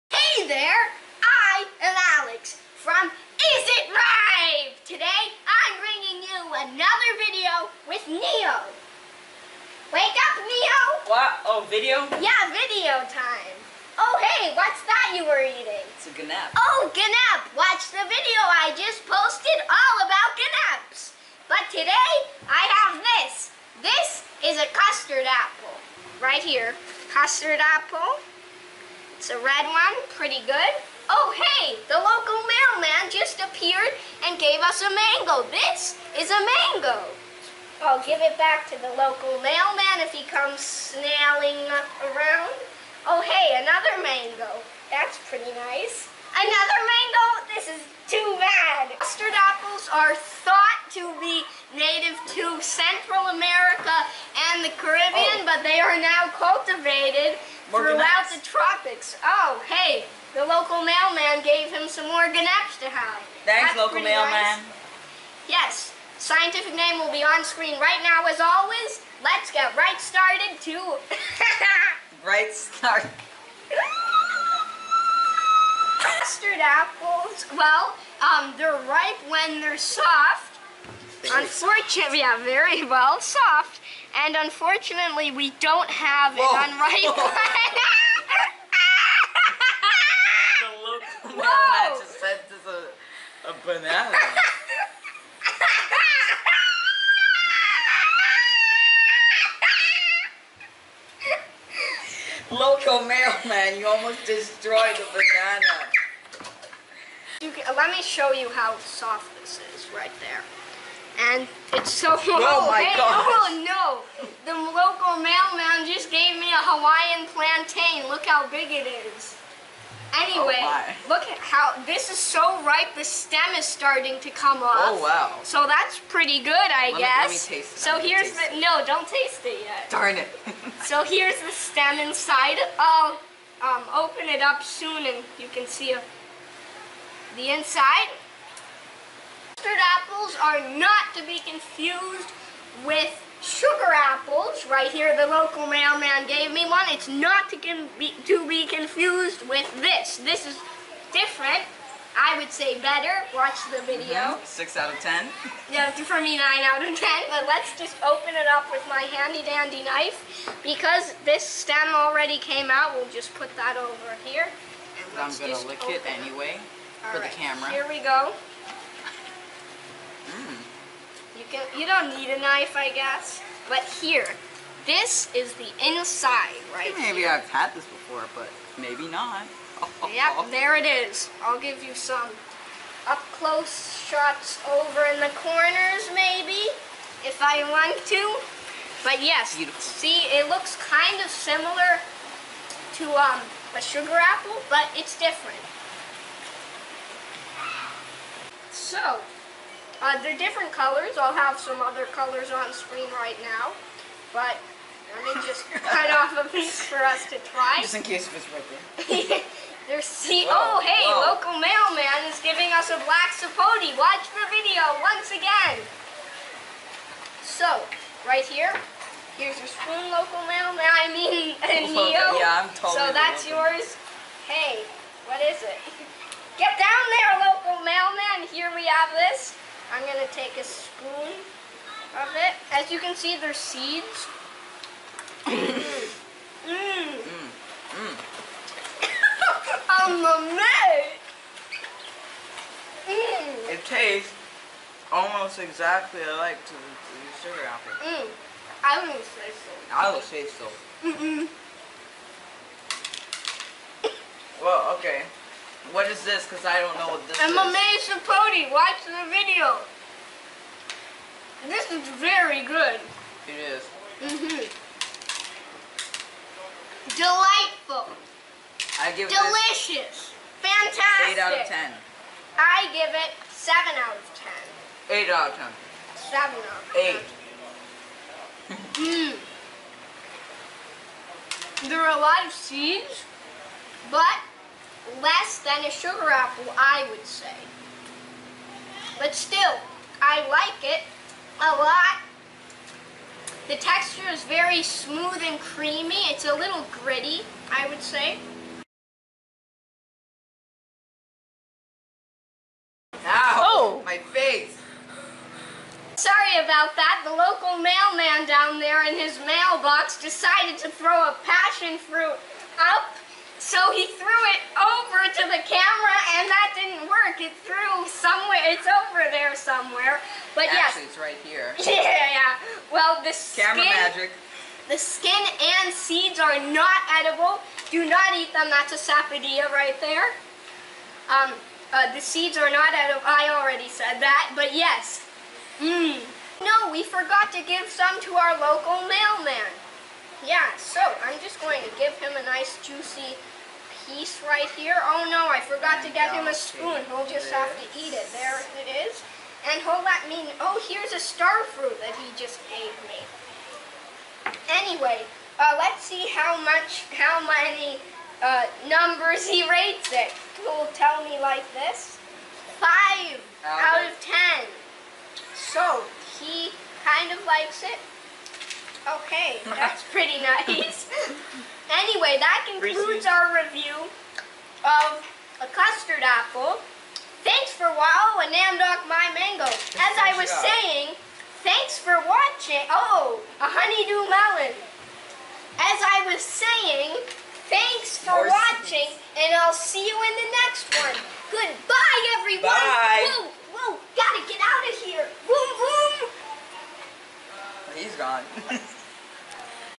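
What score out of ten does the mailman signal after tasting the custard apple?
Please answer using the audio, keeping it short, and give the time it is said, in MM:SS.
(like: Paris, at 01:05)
5, at 06:02.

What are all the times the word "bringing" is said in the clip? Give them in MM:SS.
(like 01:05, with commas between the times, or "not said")
00:05.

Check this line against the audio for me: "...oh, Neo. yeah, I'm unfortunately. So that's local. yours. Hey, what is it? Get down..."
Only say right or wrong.
wrong.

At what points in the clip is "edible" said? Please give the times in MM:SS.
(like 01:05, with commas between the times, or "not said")
05:27, 05:32.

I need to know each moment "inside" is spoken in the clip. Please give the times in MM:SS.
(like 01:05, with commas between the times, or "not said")
02:11, 02:17, 02:55.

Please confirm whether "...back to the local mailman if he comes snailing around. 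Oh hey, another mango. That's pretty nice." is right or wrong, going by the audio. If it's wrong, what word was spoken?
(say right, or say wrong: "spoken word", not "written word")
right.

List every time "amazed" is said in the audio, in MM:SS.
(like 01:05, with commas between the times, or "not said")
04:00.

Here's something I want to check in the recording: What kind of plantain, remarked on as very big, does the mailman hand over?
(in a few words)
Hawaiian plantain.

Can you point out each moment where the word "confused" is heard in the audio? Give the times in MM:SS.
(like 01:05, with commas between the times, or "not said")
02:21, 02:28.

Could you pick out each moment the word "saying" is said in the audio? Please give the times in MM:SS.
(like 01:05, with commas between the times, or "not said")
06:20, 06:26.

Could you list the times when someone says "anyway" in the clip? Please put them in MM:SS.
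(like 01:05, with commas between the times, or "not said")
02:00, 02:46, 05:54, 06:11.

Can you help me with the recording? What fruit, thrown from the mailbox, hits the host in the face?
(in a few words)
Passion fruit.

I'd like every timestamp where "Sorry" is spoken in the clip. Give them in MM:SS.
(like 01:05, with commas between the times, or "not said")
05:06.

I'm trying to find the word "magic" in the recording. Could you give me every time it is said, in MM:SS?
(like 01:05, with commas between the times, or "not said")
05:23.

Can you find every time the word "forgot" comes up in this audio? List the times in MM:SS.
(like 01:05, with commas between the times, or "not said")
05:37, 05:45.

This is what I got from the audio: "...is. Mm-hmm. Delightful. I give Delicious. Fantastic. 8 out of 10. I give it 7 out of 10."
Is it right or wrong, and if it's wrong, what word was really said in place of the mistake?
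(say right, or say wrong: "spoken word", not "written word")
right.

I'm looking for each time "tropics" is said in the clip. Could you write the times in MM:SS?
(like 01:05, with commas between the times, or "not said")
00:58.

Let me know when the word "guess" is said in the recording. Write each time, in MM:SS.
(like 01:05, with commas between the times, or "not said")
02:06, 02:52.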